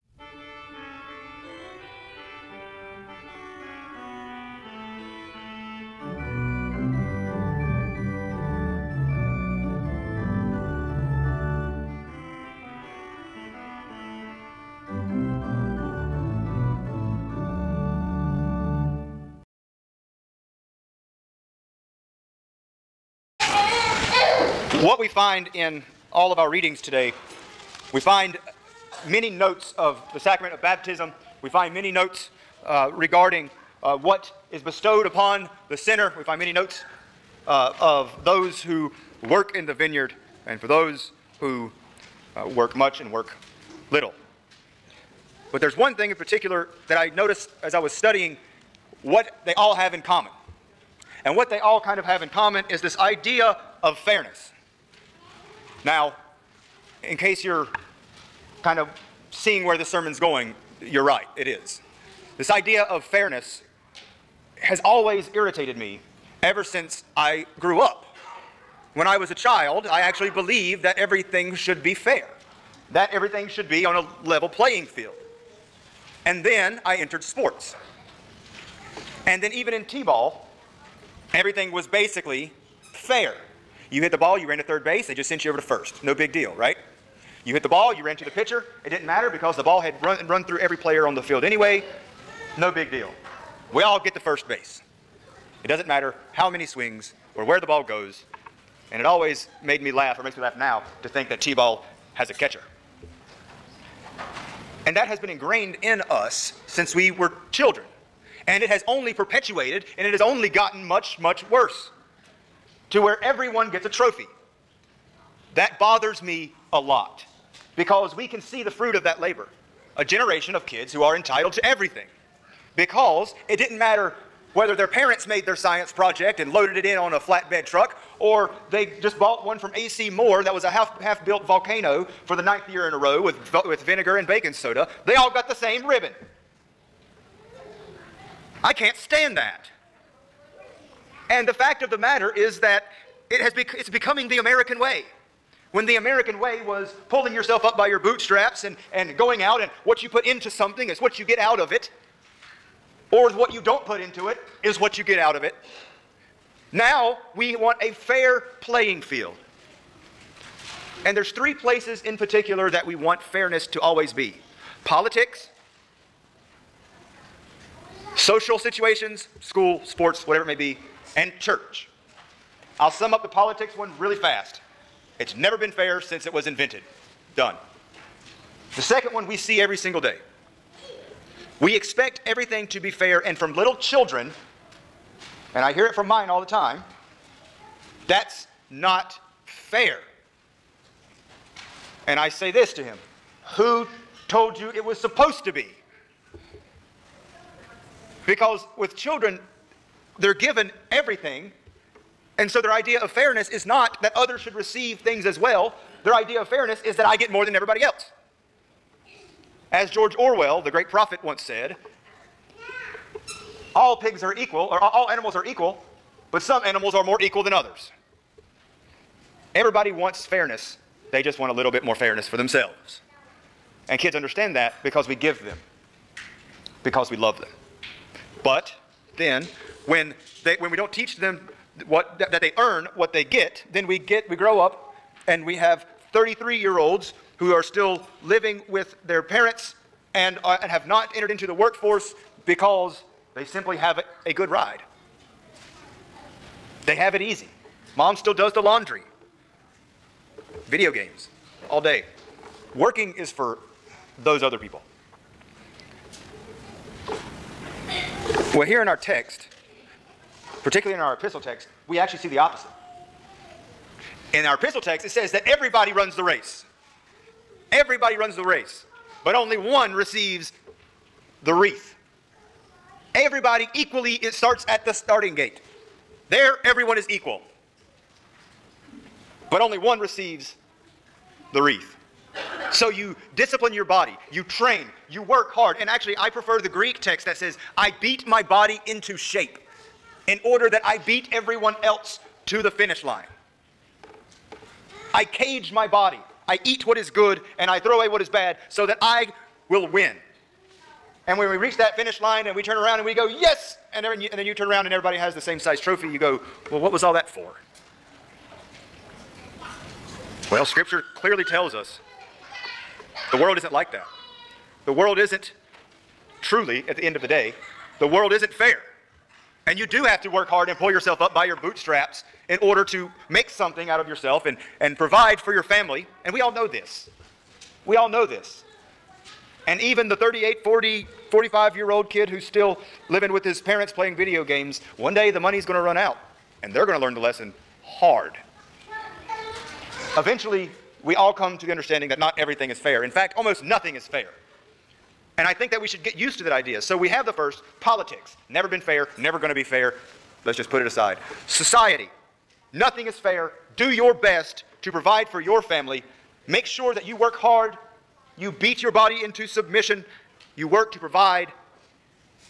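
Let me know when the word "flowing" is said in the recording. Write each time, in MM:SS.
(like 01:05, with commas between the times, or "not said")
not said.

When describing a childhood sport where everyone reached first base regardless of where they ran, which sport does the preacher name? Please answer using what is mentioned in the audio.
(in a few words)
T-ball.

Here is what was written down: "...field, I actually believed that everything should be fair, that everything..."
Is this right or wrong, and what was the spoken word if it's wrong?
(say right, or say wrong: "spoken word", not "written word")
wrong: "child", not "field".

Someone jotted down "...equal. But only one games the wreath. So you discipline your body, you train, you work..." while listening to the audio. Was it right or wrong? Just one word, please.
wrong.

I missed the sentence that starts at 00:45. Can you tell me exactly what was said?
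But there's one thing in particular that I noticed as I was studying what they all have in common.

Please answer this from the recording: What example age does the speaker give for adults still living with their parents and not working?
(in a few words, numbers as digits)
33.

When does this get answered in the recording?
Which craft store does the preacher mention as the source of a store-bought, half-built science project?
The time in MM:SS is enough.
02:09.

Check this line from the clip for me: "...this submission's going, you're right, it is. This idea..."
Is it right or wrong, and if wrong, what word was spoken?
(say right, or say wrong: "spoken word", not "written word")
wrong: "sermon", not "submission".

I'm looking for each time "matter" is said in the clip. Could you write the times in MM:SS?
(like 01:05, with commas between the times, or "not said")
01:29, 01:35, 02:03, 02:21.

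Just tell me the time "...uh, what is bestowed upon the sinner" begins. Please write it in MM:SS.
00:33.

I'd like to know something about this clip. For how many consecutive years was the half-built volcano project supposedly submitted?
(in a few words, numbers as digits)
9.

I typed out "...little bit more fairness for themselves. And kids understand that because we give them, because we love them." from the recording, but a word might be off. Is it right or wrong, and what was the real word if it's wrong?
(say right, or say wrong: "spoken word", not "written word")
right.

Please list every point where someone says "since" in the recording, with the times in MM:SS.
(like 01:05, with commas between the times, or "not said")
01:06, 01:46, 02:55.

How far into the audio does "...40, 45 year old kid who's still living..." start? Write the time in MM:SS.
05:30.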